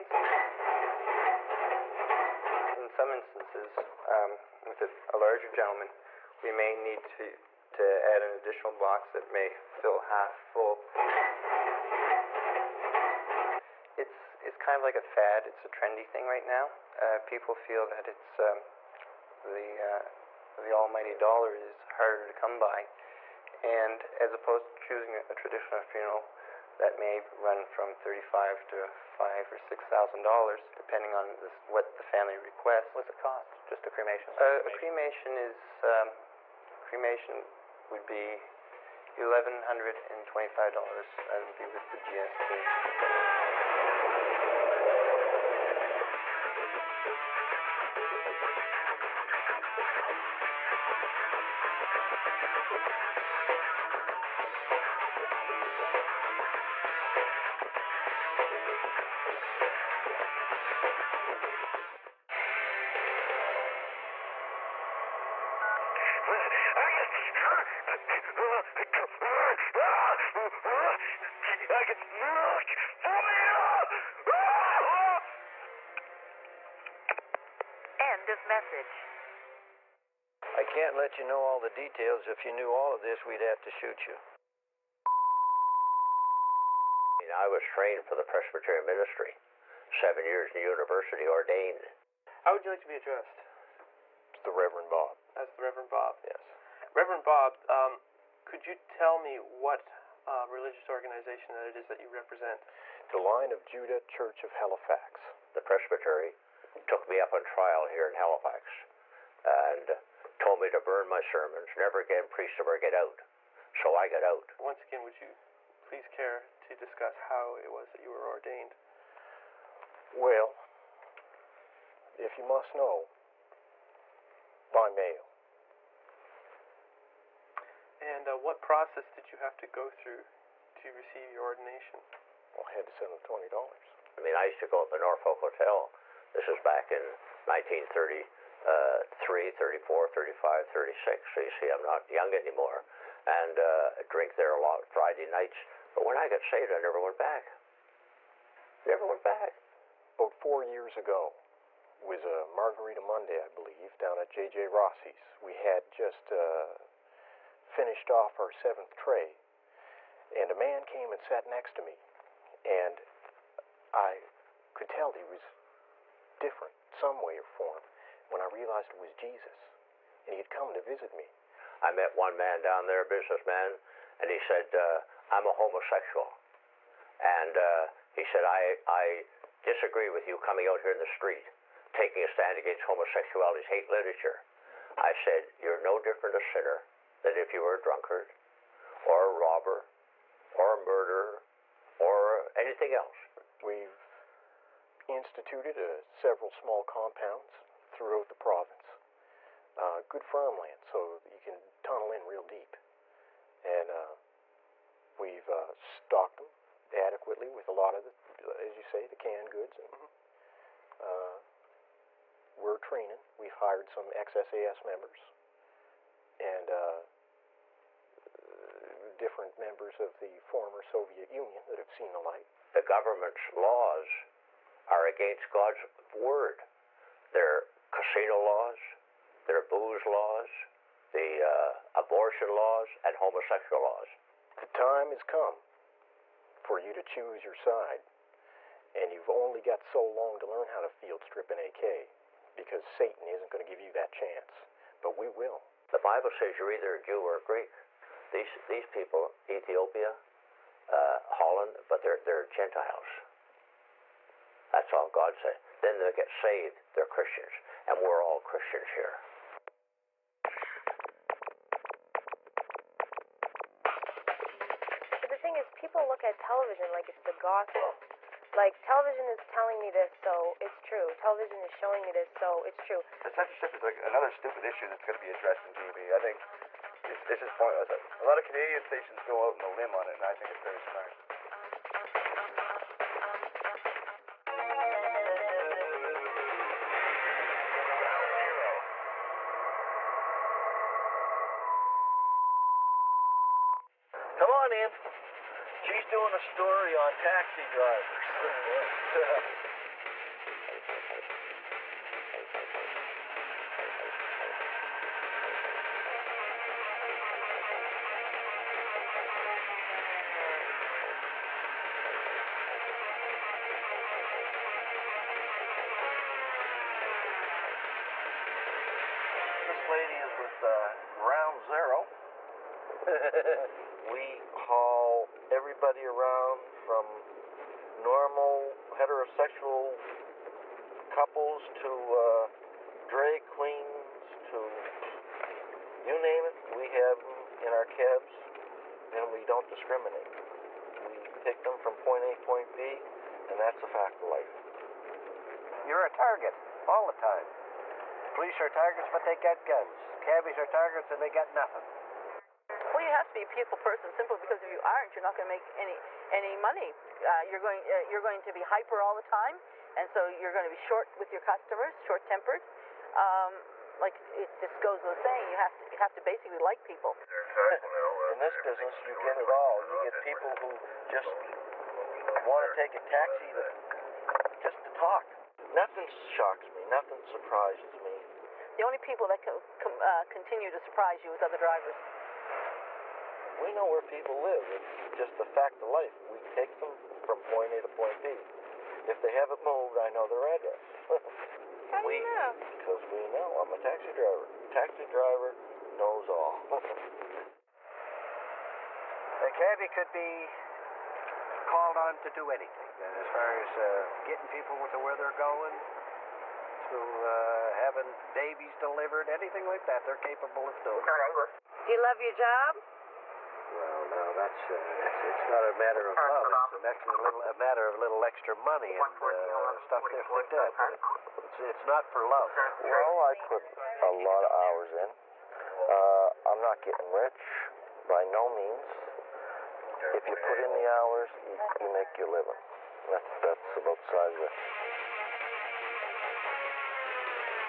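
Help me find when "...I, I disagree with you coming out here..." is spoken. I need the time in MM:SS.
02:58.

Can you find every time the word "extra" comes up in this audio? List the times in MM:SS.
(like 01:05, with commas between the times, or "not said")
06:58.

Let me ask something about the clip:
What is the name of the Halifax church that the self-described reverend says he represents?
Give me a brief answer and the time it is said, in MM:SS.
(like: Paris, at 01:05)
The Line of Judah Church, at 01:43.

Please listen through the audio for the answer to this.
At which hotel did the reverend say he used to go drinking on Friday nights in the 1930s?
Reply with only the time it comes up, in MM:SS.
02:14.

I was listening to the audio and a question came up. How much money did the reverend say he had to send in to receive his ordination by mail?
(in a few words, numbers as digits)
$20.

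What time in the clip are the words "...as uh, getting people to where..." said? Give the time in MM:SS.
06:43.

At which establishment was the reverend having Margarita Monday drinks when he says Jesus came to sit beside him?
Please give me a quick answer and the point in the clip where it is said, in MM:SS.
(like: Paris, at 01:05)
J.J. Rossi's, at 02:34.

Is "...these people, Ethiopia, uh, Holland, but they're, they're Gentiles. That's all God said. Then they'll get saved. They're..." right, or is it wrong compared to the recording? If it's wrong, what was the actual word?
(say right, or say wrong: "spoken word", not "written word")
right.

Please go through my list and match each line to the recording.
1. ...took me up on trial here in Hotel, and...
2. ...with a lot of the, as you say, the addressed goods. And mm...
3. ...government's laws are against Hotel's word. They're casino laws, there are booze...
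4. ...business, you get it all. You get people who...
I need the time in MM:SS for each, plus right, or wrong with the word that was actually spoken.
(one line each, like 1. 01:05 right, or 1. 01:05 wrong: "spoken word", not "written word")
1. 01:46 wrong: "Halifax", not "Hotel"
2. 03:27 wrong: "canned", not "addressed"
3. 03:42 wrong: "God", not "Hotel"
4. 06:08 right.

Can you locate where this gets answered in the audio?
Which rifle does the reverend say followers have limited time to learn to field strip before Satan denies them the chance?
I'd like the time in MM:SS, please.
04:01.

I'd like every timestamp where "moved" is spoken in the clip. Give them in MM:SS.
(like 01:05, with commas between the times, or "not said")
06:29.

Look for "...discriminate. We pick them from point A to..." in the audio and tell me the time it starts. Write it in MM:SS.
05:39.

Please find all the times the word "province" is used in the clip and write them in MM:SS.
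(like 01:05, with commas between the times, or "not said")
03:18.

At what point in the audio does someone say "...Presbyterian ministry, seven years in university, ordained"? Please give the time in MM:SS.
01:28.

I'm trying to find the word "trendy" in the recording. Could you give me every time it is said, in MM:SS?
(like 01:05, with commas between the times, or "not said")
00:15.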